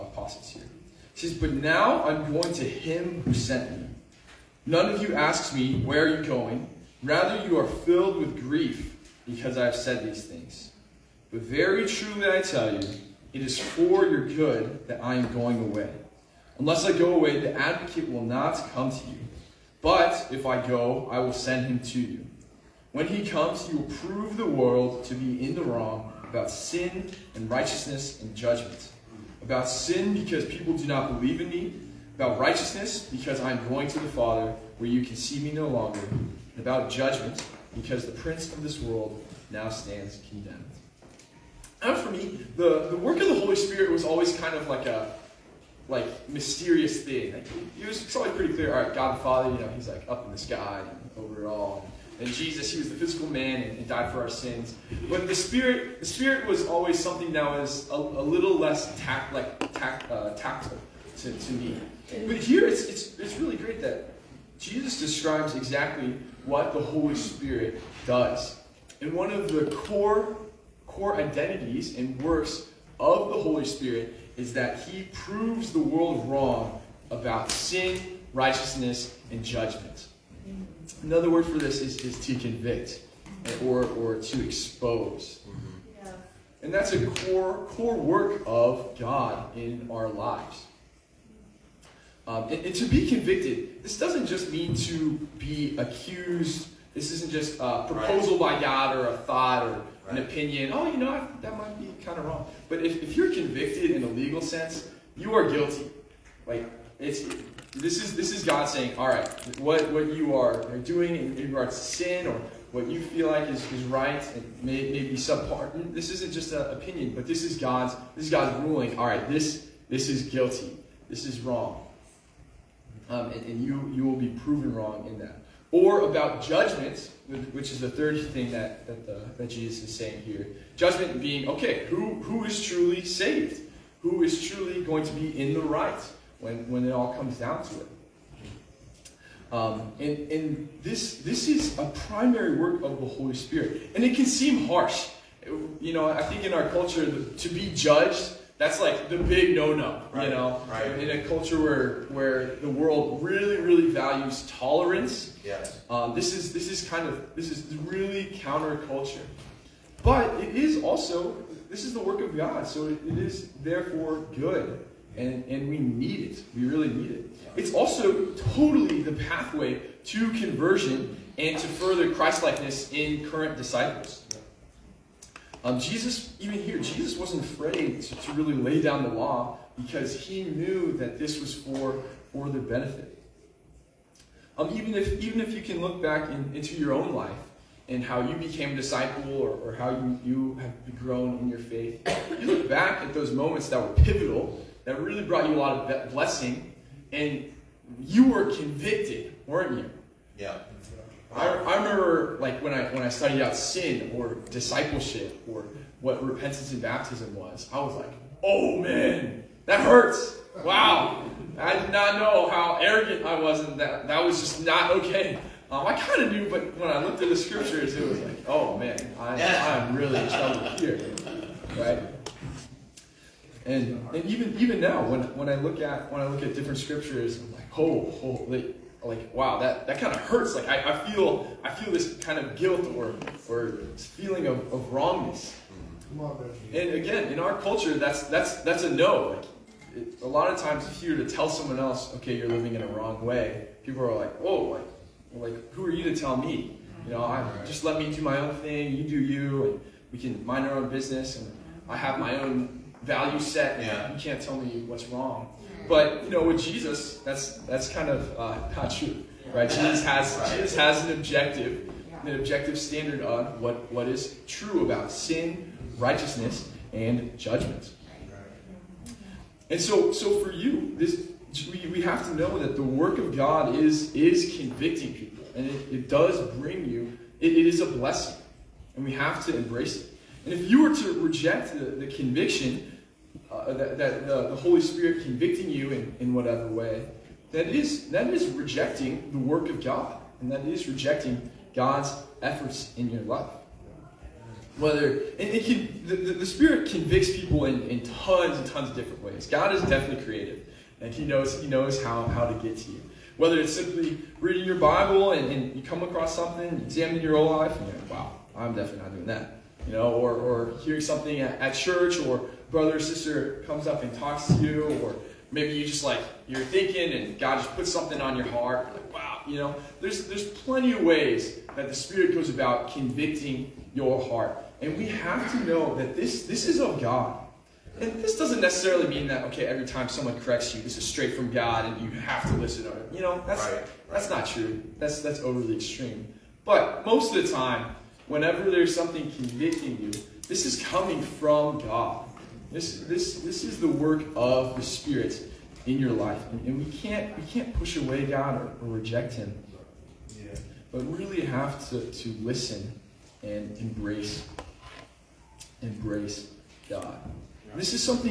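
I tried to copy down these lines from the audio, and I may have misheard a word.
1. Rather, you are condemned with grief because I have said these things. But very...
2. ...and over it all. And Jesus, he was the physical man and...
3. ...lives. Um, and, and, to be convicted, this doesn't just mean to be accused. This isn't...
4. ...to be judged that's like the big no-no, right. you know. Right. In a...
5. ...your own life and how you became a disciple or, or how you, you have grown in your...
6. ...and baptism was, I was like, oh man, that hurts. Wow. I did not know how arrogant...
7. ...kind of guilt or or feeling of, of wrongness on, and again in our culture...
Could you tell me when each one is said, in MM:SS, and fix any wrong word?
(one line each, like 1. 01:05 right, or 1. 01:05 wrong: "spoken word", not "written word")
1. 00:07 wrong: "filled", not "condemned"
2. 00:50 right
3. 01:30 right
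4. 02:27 right
5. 03:06 right
6. 03:26 right
7. 03:52 right.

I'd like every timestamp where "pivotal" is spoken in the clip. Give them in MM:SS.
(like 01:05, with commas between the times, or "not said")
03:13.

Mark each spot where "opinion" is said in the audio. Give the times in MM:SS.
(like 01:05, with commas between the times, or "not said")
01:40, 01:56.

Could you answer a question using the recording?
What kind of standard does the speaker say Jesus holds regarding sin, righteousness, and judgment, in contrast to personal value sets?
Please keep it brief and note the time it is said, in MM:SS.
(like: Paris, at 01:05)
objective standard, at 04:22.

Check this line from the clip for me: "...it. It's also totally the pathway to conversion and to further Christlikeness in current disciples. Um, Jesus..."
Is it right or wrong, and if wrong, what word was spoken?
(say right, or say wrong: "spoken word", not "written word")
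right.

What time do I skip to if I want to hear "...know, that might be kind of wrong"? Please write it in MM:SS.
01:40.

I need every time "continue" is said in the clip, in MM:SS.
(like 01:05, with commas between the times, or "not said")
not said.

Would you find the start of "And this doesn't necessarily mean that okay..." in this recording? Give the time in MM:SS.
05:28.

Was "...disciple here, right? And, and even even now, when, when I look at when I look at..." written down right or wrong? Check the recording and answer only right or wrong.
wrong.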